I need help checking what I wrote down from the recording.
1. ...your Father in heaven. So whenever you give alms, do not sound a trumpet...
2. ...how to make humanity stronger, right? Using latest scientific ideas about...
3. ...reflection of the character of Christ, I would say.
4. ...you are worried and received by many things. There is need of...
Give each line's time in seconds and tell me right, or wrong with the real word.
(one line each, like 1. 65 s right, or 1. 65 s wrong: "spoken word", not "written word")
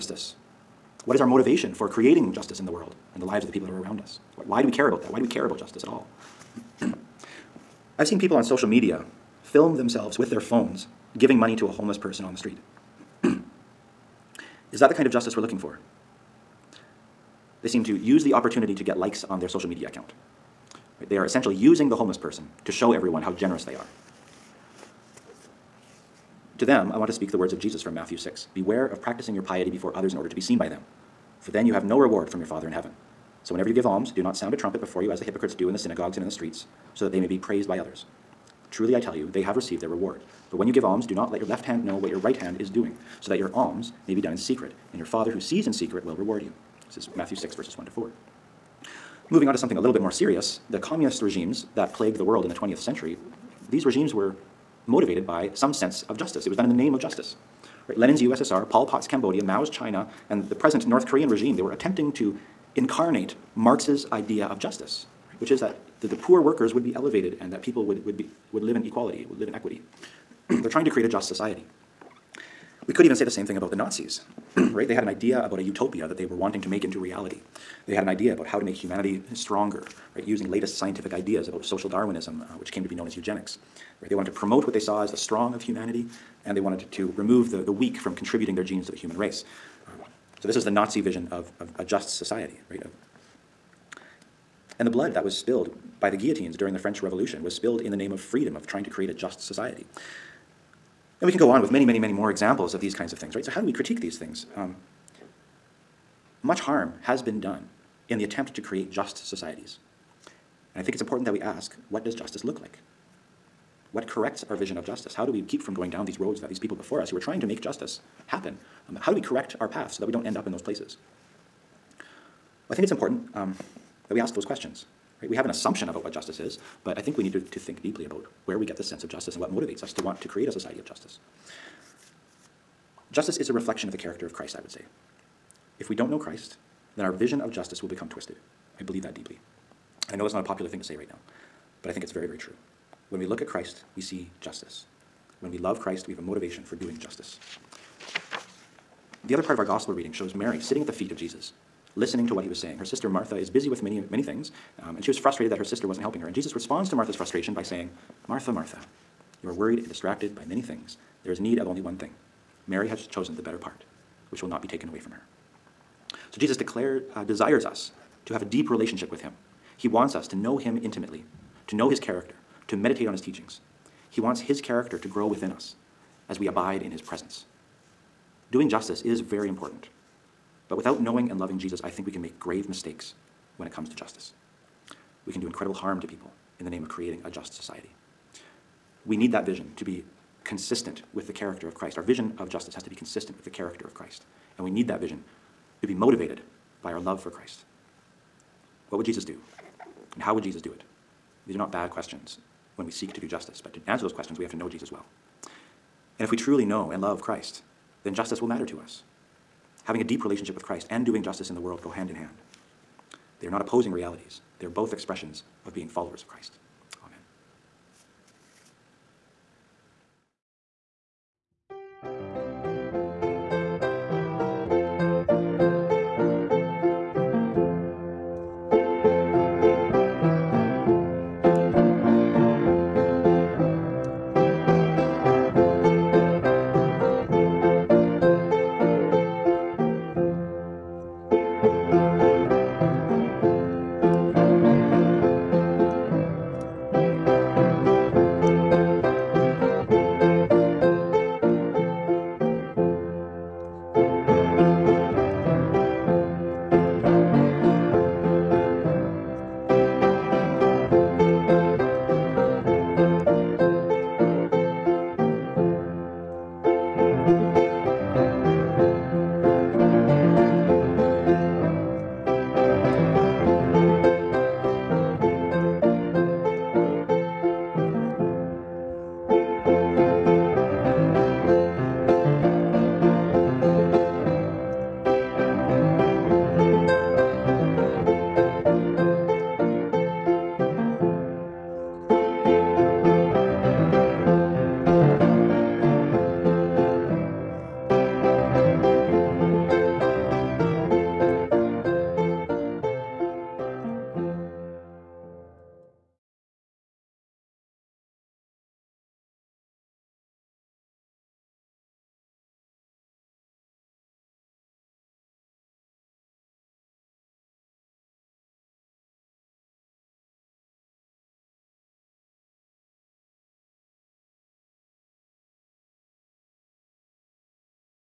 1. 32 s right
2. 78 s right
3. 133 s right
4. 159 s wrong: "distracted", not "received".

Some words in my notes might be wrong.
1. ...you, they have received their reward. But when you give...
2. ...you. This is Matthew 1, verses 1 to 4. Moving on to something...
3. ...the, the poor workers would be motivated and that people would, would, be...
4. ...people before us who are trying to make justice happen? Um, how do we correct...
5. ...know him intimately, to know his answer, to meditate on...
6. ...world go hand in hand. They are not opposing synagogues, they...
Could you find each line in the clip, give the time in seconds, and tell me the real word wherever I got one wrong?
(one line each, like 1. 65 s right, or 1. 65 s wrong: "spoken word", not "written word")
1. 39 s right
2. 46 s wrong: "6", not "1"
3. 66 s wrong: "elevated", not "motivated"
4. 116 s right
5. 170 s wrong: "character", not "answer"
6. 211 s wrong: "realities", not "synagogues".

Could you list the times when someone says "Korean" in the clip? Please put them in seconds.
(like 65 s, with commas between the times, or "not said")
61 s.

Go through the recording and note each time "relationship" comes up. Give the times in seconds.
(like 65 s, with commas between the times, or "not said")
168 s, 210 s.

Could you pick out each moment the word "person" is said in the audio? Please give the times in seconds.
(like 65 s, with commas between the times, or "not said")
11 s, 22 s.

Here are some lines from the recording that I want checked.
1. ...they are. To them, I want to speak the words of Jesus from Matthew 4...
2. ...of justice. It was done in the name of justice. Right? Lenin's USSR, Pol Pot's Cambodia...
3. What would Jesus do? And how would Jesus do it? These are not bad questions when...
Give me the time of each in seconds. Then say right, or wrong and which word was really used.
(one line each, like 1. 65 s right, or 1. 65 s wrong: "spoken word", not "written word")
1. 23 s wrong: "6", not "4"
2. 56 s right
3. 198 s right.